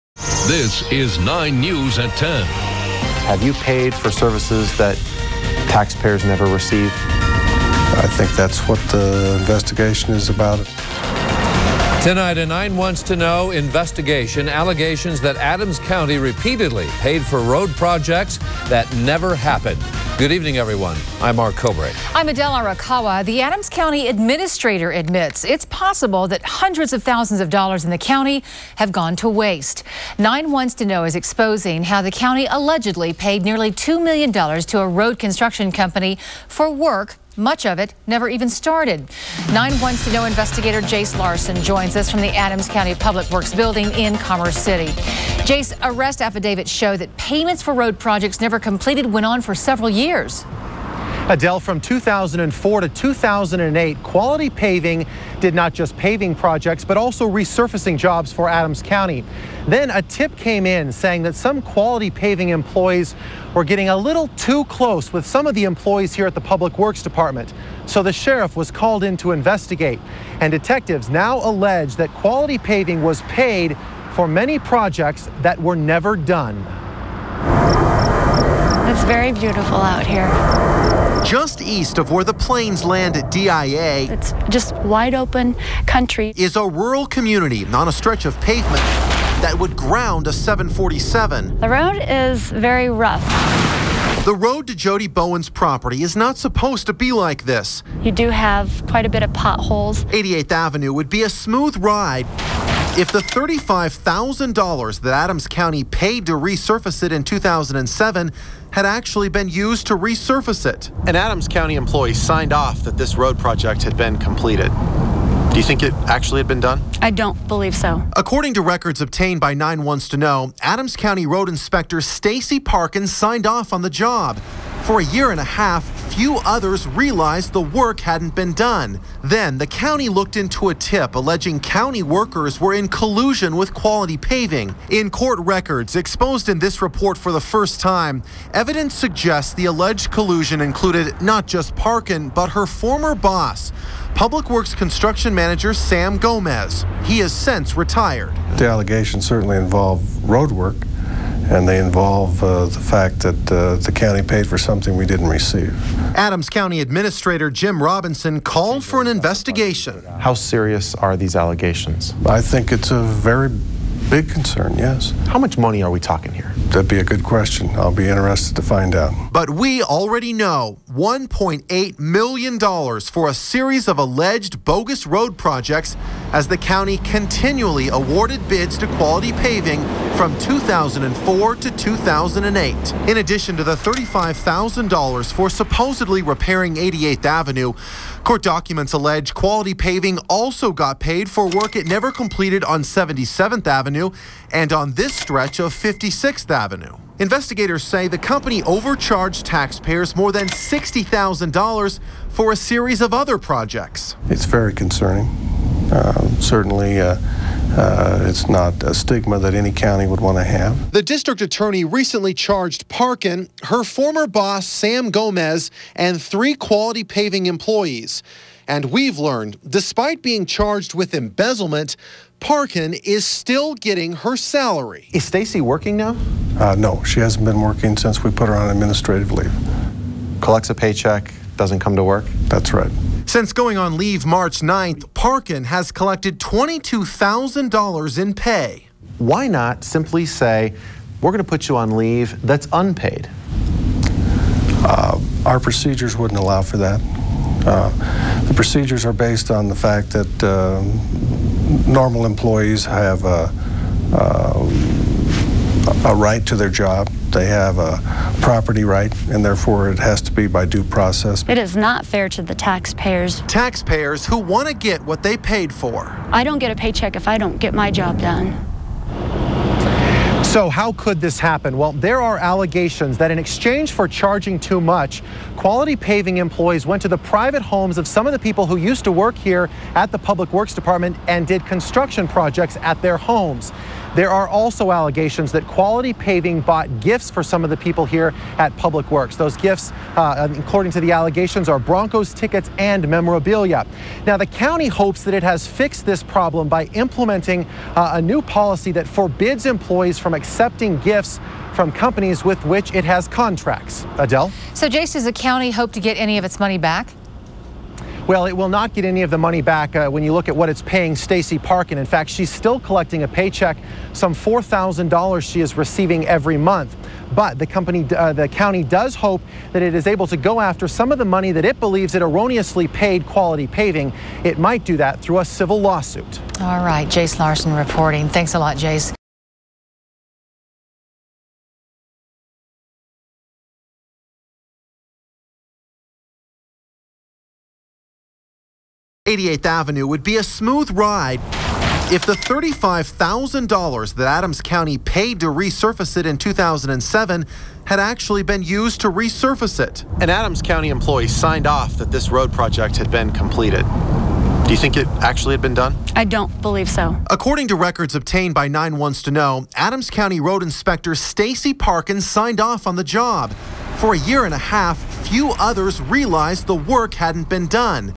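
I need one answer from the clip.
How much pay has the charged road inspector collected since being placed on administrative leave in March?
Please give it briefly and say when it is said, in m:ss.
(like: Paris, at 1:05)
$22,000, at 3:56.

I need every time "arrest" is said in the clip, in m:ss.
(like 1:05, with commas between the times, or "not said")
0:45.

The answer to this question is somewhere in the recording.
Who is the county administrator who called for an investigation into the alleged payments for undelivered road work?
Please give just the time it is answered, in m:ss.
2:37.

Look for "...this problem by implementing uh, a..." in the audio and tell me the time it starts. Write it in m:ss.
4:56.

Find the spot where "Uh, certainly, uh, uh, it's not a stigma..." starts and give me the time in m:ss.
3:25.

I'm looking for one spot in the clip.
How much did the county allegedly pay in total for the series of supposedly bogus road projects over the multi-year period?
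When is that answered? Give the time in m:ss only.
2:50.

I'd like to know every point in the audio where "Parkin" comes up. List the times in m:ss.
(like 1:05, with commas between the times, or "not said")
2:02, 2:21, 3:32, 3:42, 3:55, 5:11, 6:01.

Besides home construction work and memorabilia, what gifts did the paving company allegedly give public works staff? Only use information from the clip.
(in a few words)
Broncos tickets.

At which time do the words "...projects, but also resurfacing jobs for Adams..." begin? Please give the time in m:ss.
0:56.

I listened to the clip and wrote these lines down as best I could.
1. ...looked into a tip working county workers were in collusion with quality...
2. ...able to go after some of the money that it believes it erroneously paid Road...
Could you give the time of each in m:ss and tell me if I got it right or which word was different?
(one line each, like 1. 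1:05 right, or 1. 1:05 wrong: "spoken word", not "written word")
1. 2:10 wrong: "alleging", not "working"
2. 5:20 wrong: "Quality", not "Road".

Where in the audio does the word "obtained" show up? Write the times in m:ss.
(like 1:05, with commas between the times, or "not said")
1:58, 5:58.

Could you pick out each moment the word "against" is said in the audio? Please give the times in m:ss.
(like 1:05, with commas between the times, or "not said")
not said.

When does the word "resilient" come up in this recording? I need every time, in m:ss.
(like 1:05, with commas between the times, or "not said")
not said.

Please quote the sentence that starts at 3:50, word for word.
Collects a paycheck, doesn't come to work?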